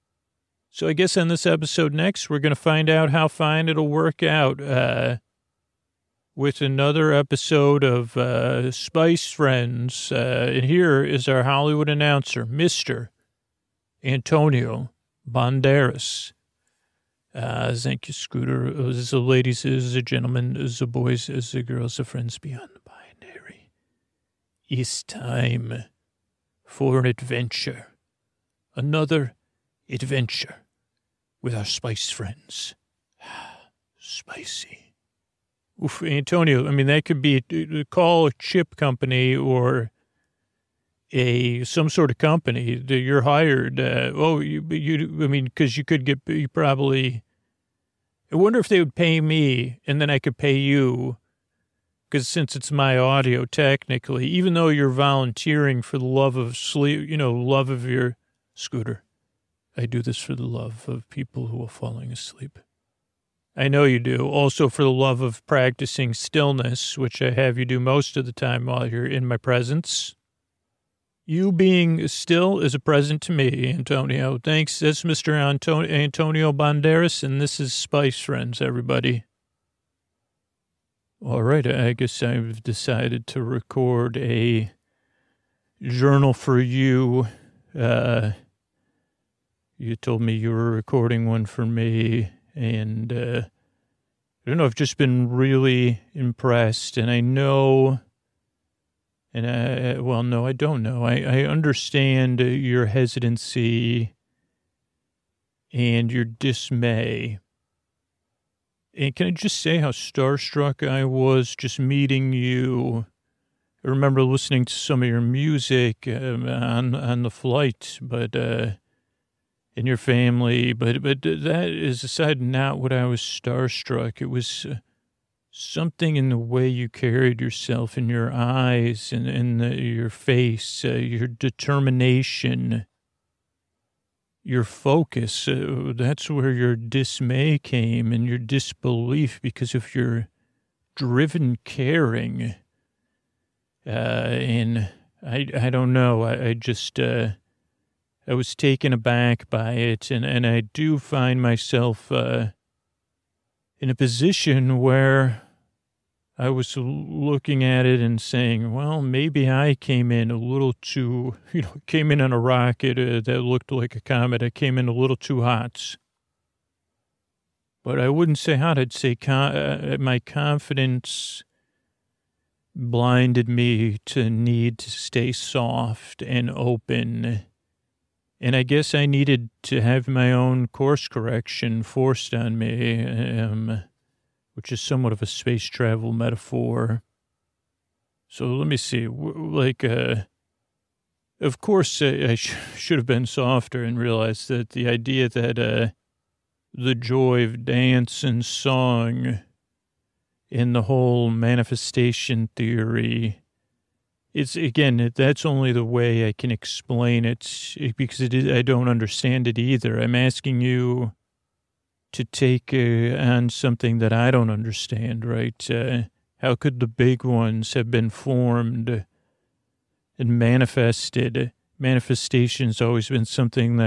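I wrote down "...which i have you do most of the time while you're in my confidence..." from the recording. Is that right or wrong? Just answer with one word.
wrong.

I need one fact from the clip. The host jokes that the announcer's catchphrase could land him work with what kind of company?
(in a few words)
A chip company.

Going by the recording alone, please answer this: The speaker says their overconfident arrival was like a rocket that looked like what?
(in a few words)
A comet.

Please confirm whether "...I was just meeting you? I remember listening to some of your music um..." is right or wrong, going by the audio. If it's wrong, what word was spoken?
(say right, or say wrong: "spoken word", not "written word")
right.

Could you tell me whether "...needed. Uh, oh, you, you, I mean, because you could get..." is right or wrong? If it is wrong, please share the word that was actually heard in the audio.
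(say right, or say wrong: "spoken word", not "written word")
wrong: "hired", not "needed".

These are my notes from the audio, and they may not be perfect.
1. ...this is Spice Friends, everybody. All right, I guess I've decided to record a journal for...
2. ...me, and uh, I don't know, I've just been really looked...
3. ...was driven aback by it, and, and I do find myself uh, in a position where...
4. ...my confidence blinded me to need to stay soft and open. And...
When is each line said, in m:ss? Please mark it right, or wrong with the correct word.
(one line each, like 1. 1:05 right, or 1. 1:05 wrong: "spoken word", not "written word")
1. 1:17 right
2. 1:31 wrong: "impressed", not "looked"
3. 2:28 wrong: "taken", not "driven"
4. 2:50 right.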